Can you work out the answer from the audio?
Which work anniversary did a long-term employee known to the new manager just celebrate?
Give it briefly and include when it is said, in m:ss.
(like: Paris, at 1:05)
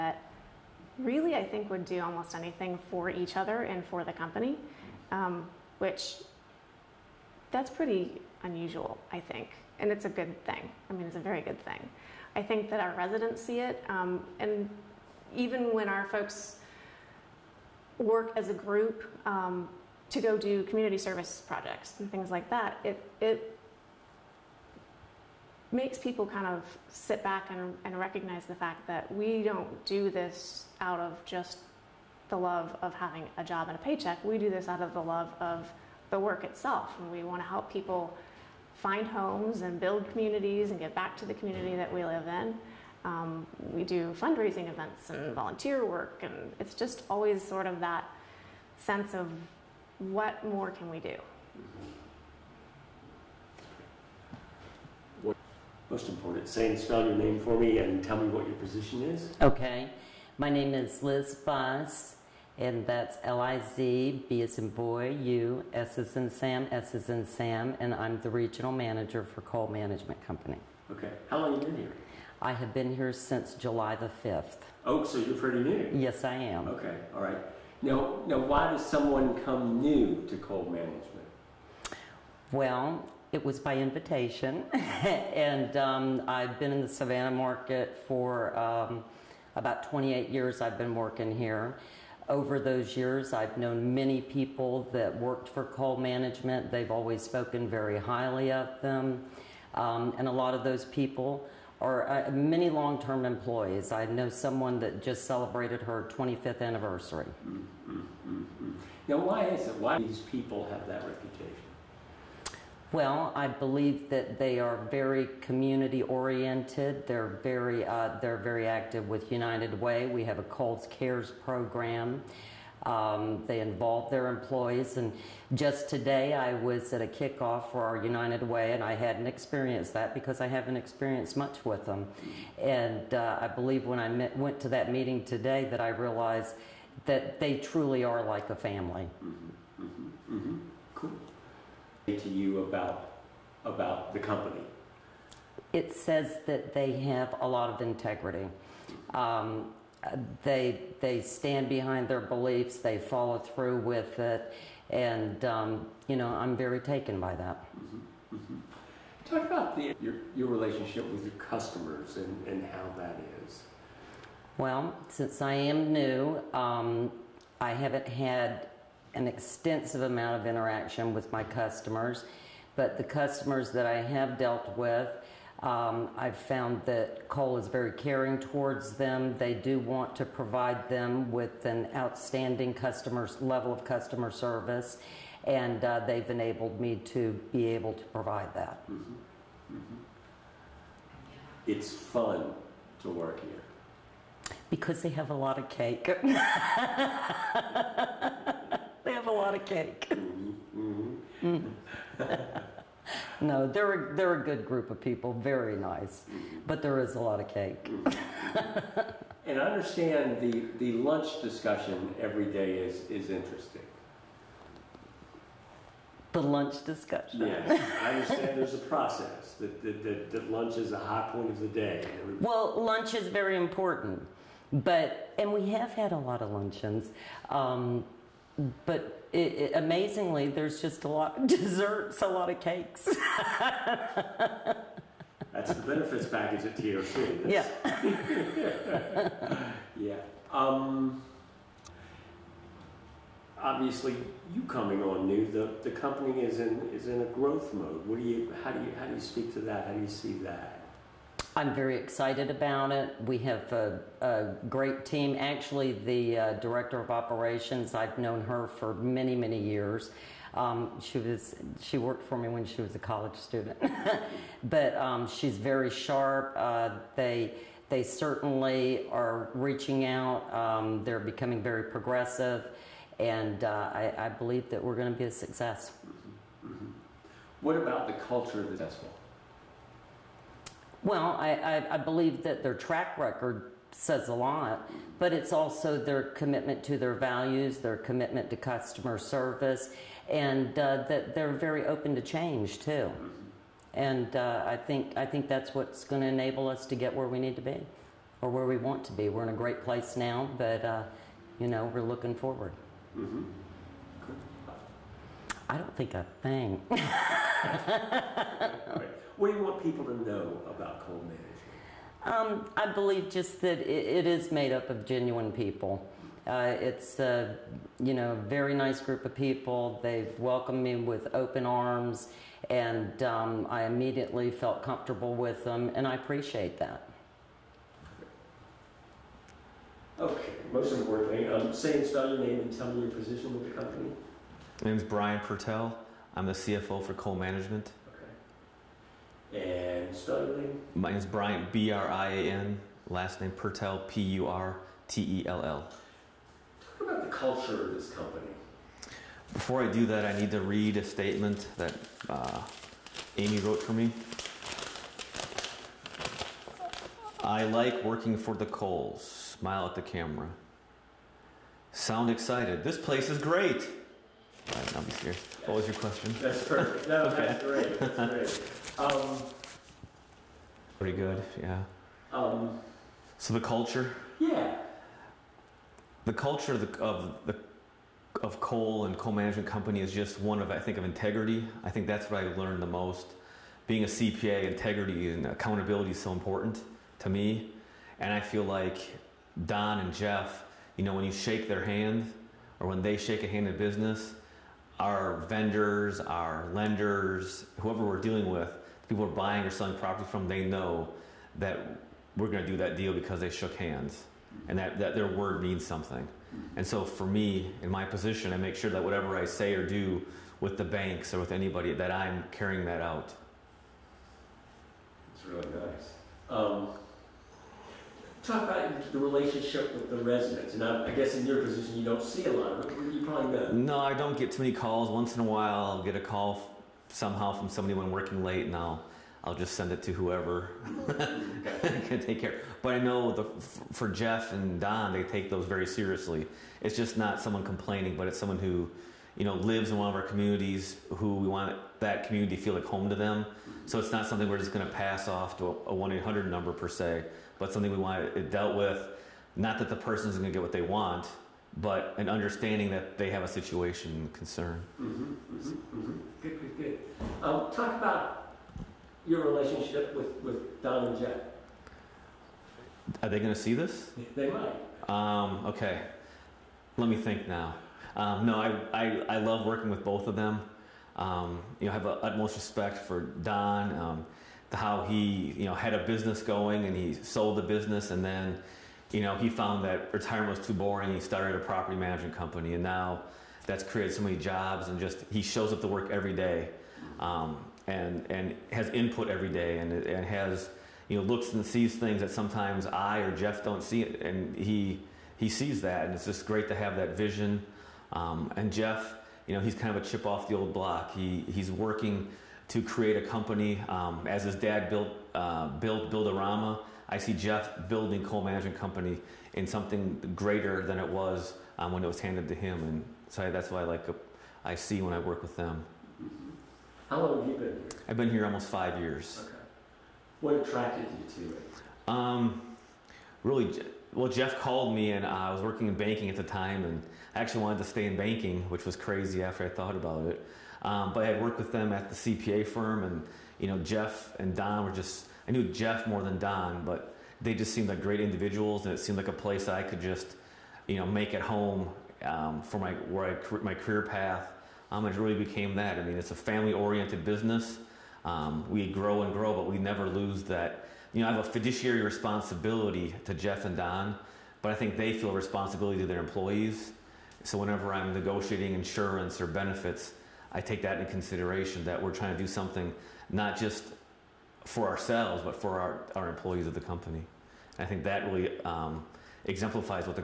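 25th, at 1:46.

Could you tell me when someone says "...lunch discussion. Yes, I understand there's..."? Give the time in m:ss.
3:36.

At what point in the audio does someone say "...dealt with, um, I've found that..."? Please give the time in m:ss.
2:54.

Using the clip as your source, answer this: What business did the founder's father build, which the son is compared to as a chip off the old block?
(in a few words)
Builderama.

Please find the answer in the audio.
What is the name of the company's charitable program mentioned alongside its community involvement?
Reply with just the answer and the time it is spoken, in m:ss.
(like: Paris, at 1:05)
Coles Cares, at 2:00.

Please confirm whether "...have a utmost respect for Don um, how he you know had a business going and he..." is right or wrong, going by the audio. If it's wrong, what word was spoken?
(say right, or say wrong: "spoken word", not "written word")
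right.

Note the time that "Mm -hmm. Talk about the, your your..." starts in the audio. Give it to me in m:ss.
2:38.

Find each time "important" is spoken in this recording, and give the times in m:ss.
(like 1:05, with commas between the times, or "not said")
0:56, 3:43, 5:30, 6:26.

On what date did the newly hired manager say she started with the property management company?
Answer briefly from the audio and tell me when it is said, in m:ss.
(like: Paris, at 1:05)
July 5th, at 1:13.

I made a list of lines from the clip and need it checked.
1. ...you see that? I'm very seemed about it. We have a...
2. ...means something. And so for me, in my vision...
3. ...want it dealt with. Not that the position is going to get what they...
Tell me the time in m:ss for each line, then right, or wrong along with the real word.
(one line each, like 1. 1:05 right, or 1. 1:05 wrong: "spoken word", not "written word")
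1. 4:10 wrong: "excited", not "seemed"
2. 6:45 wrong: "position", not "vision"
3. 7:27 wrong: "person", not "position".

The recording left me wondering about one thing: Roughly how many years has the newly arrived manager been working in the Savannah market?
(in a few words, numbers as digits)
28.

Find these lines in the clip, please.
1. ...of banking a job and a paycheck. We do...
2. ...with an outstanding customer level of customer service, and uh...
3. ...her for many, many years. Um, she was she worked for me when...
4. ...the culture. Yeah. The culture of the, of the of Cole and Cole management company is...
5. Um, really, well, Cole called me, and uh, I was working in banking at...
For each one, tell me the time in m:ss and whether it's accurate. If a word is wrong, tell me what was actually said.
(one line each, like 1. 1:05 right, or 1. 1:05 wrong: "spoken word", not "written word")
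1. 0:32 wrong: "having", not "banking"
2. 3:01 right
3. 4:18 right
4. 6:13 right
5. 8:42 wrong: "Jeff", not "Cole".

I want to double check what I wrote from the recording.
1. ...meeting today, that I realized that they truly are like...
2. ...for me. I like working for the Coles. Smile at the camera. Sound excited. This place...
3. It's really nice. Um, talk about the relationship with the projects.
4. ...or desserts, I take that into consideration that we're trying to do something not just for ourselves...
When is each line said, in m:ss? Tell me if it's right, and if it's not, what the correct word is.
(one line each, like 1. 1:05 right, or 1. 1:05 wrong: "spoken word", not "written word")
1. 2:14 right
2. 5:53 right
3. 6:55 wrong: "residents", not "projects"
4. 9:19 wrong: "benefits", not "desserts".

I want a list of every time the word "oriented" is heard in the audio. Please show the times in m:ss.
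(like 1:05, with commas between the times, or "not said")
1:56, 9:06.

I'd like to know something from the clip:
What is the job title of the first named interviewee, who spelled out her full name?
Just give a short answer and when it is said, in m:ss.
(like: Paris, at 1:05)
Regional manager, at 1:08.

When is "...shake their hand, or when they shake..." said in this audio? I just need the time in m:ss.
6:31.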